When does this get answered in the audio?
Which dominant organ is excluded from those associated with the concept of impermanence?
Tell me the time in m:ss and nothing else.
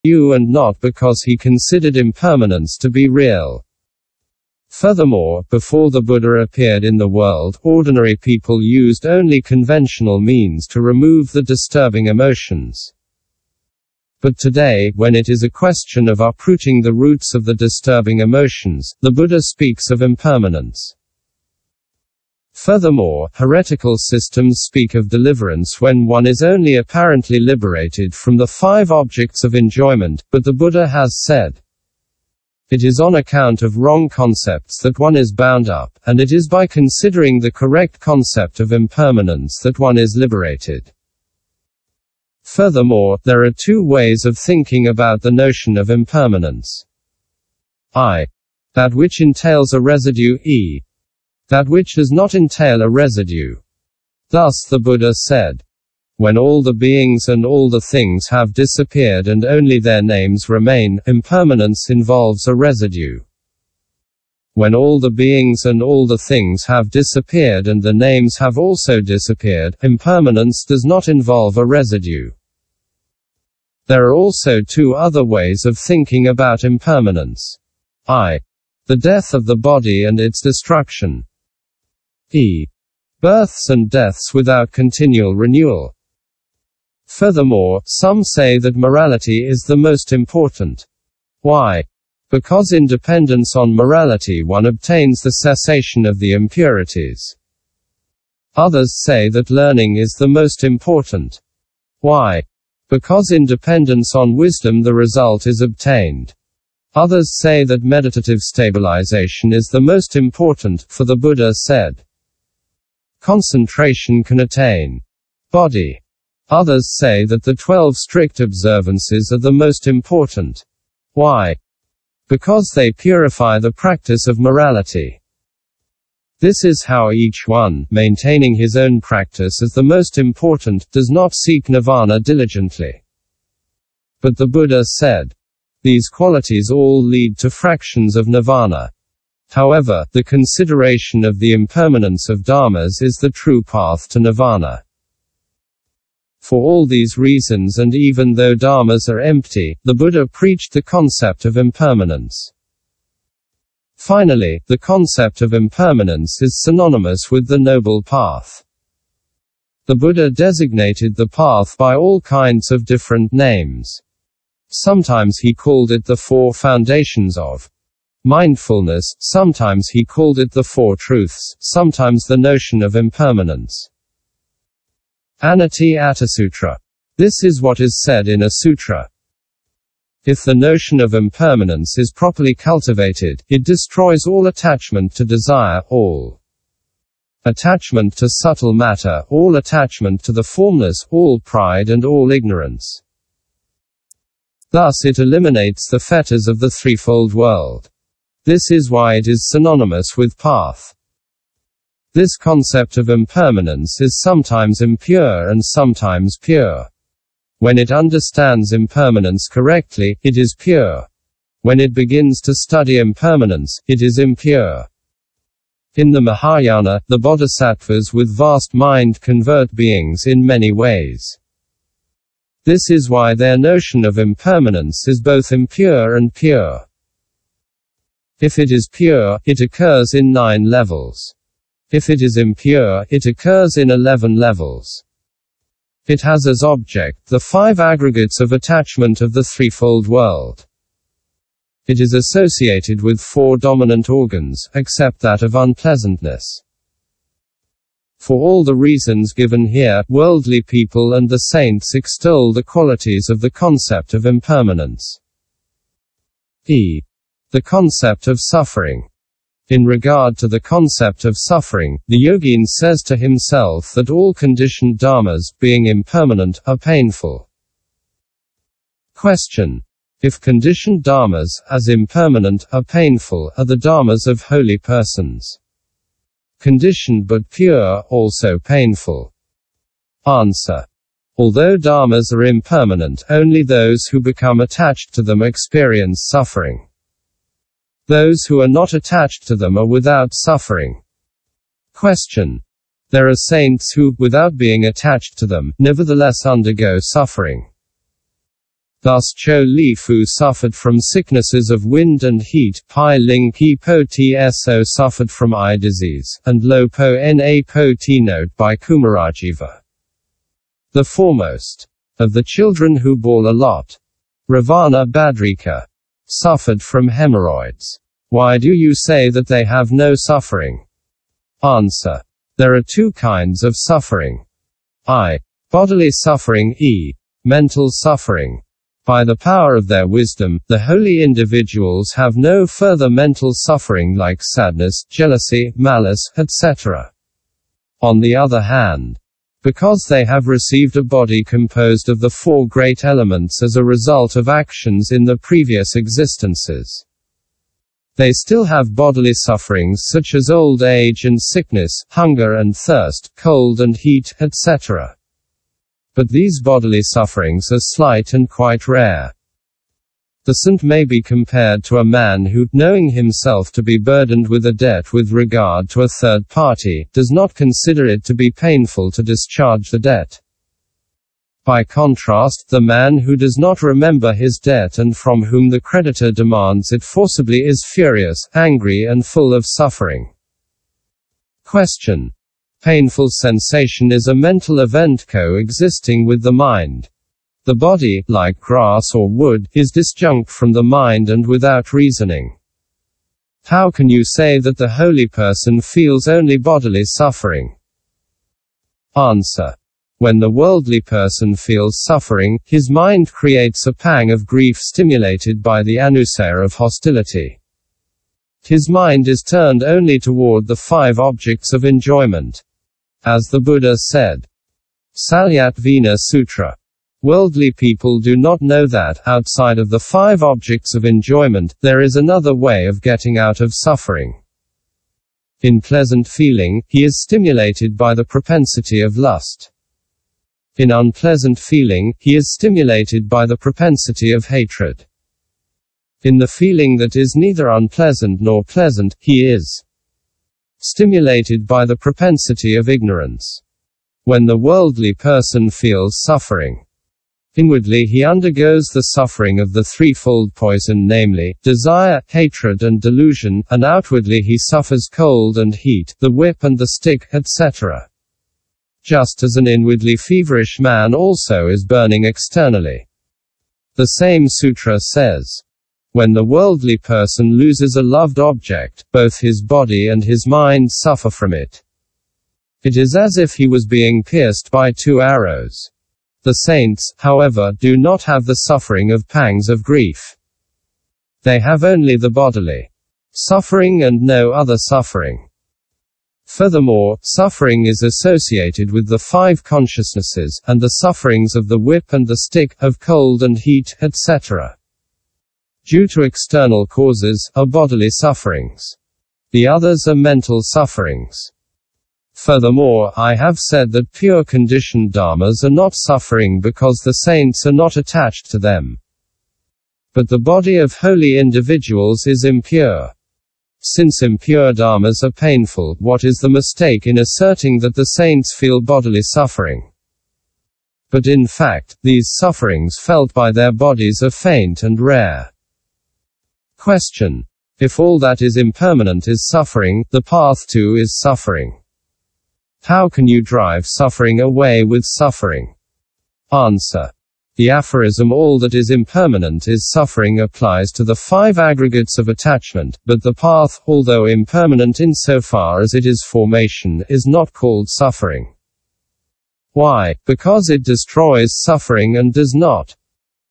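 4:05.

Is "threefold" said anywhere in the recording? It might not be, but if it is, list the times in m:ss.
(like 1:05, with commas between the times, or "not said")
3:16, 3:59, 7:29.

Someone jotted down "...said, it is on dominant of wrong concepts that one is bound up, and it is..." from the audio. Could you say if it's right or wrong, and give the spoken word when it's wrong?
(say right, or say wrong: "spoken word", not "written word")
wrong: "account", not "dominant".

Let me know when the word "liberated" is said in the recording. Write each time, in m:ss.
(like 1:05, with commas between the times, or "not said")
0:27, 0:40.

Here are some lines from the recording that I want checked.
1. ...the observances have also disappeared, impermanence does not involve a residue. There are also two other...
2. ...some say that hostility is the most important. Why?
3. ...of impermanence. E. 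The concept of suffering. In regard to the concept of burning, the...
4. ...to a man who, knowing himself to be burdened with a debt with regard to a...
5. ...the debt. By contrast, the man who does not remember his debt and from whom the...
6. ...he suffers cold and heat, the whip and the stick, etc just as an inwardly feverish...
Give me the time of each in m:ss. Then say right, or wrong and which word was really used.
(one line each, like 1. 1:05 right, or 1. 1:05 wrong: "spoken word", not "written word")
1. 1:07 wrong: "names", not "observances"
2. 1:27 wrong: "morality", not "hostility"
3. 4:14 wrong: "suffering", not "burning"
4. 6:01 right
5. 6:09 right
6. 7:34 right.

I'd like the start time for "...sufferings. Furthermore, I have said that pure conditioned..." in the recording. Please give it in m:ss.
8:20.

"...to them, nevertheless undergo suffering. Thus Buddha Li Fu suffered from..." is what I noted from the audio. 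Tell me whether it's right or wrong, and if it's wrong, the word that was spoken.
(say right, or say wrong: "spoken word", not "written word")
wrong: "Cho", not "Buddha".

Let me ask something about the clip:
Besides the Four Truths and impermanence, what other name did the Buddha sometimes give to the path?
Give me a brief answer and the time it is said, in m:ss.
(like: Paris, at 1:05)
Four Foundations of Mindfulness, at 2:46.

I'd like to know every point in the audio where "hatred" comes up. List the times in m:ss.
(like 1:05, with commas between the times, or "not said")
7:14, 7:32.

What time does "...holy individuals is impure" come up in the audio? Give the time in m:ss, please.
8:30.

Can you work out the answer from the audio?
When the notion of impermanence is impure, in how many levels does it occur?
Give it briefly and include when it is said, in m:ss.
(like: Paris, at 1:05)
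11, at 3:53.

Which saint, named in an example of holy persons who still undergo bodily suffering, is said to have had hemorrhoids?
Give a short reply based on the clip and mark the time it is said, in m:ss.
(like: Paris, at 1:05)
Ravana Badrika, at 5:14.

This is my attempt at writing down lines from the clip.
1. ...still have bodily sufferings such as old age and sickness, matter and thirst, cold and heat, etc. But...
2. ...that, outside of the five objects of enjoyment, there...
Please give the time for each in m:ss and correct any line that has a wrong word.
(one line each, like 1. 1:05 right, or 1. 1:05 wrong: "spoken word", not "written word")
1. 5:48 wrong: "hunger", not "matter"
2. 6:58 right.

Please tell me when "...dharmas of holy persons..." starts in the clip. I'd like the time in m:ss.
4:33.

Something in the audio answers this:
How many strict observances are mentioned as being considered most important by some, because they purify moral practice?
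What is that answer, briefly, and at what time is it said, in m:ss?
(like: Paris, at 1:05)
12, at 1:57.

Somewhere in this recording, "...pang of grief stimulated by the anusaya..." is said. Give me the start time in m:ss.
6:43.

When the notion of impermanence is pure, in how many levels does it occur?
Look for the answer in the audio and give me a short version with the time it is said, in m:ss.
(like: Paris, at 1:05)
9, at 3:50.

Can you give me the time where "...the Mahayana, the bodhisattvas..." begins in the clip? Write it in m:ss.
3:36.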